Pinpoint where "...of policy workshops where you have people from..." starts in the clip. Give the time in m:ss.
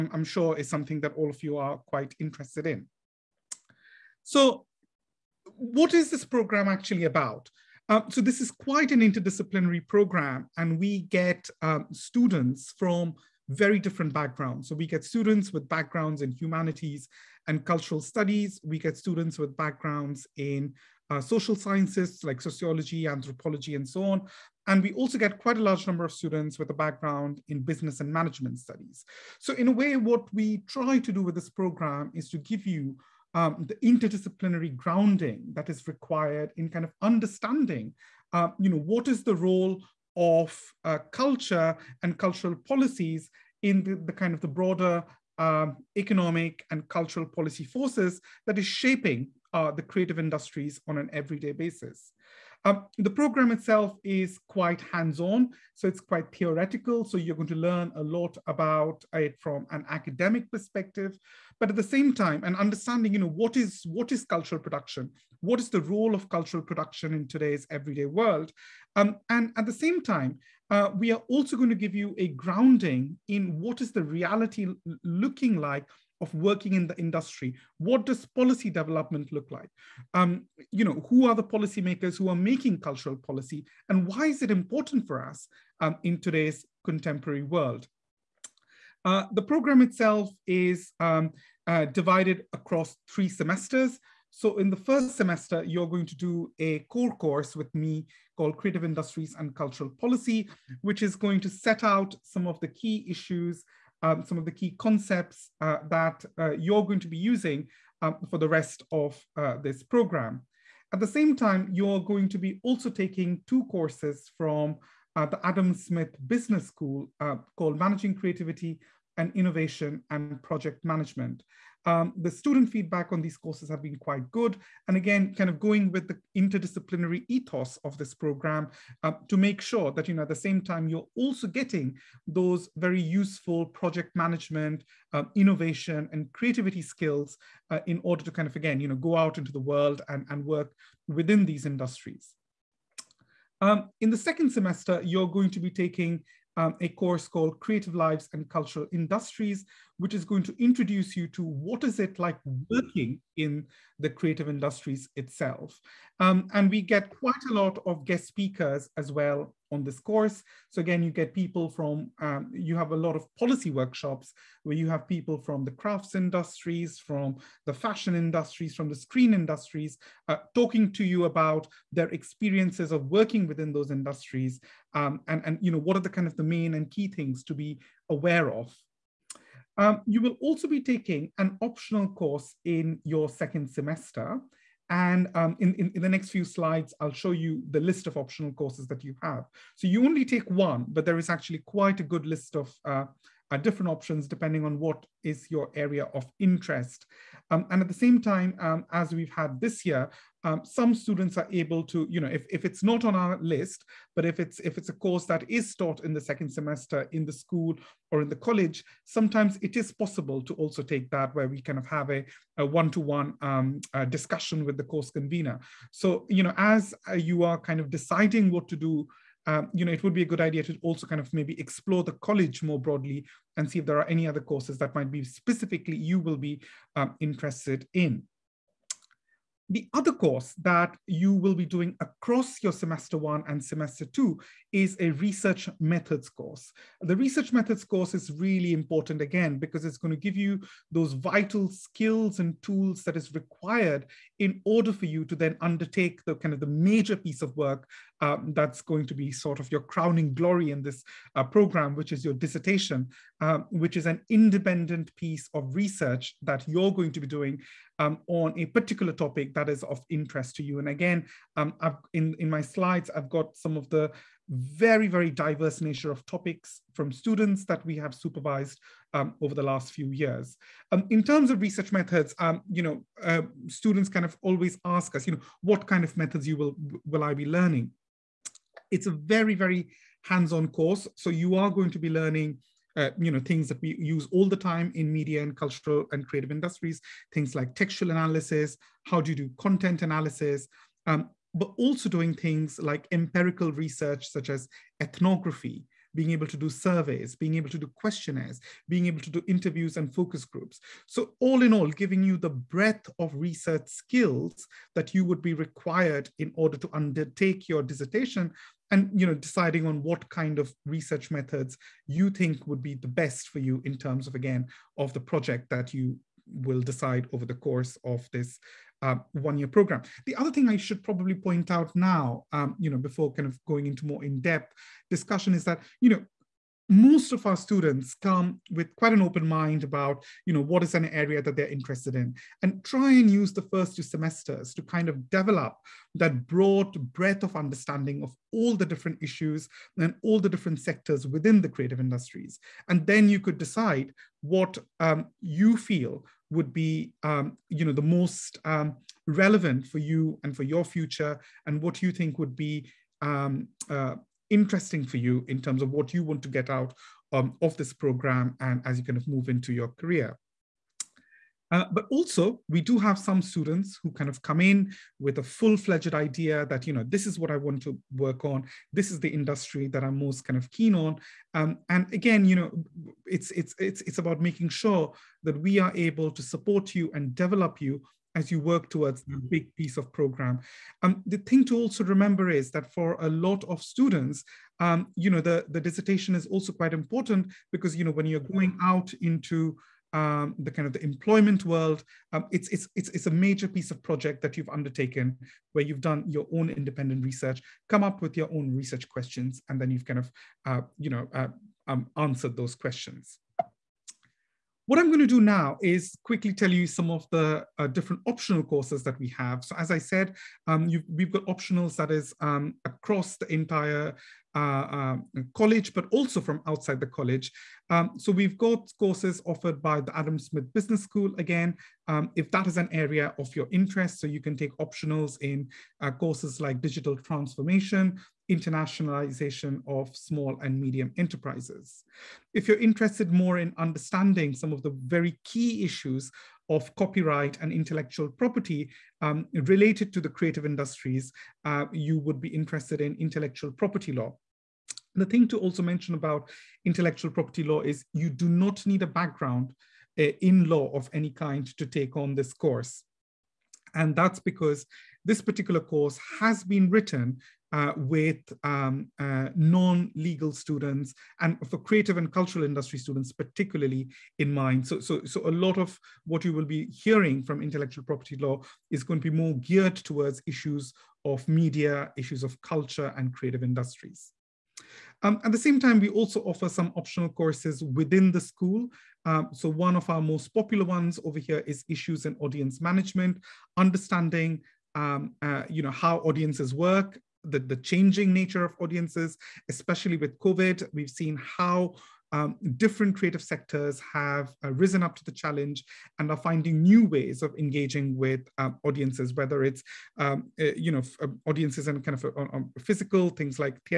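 2:43.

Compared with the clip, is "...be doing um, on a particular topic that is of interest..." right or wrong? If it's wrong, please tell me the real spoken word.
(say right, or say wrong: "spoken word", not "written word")
right.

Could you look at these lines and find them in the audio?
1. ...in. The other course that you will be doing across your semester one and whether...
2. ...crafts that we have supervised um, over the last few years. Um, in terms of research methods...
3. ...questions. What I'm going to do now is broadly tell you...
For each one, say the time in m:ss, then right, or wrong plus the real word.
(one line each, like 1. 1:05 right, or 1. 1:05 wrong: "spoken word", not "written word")
1. 3:47 wrong: "semester", not "whether"
2. 4:27 wrong: "students", not "crafts"
3. 6:42 wrong: "quickly", not "broadly".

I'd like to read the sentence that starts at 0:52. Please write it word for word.
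Um, the program itself is quite hands-on, so it's quite theoretical.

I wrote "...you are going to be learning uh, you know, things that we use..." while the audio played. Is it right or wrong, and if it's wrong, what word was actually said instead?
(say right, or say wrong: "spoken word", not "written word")
right.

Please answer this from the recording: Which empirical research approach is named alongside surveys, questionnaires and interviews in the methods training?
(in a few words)
ethnography.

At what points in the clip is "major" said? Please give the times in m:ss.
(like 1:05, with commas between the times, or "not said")
4:06, 6:33.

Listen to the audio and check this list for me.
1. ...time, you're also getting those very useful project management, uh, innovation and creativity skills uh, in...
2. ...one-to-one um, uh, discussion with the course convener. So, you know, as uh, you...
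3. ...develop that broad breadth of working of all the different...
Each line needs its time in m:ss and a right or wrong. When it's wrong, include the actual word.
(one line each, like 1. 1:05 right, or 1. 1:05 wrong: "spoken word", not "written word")
1. 2:10 right
2. 3:32 right
3. 5:35 wrong: "understanding", not "working".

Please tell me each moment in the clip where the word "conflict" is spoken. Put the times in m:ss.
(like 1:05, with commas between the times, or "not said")
not said.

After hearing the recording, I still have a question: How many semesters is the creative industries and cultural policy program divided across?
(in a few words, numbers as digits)
3.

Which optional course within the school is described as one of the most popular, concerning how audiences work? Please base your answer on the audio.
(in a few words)
Issues in Audience Management.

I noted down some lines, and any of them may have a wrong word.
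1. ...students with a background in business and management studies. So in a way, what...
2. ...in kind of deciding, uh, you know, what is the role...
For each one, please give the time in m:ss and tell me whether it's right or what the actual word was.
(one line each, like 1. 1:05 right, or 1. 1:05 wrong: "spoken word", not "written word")
1. 0:26 right
2. 0:36 wrong: "understanding", not "deciding".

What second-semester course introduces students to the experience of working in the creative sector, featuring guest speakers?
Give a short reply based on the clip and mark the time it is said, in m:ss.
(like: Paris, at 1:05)
Creative Lives and Cultural Industries, at 2:27.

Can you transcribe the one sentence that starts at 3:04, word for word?
And um, in, in, in, the next few slides, I'll show you the list of optional courses that you have.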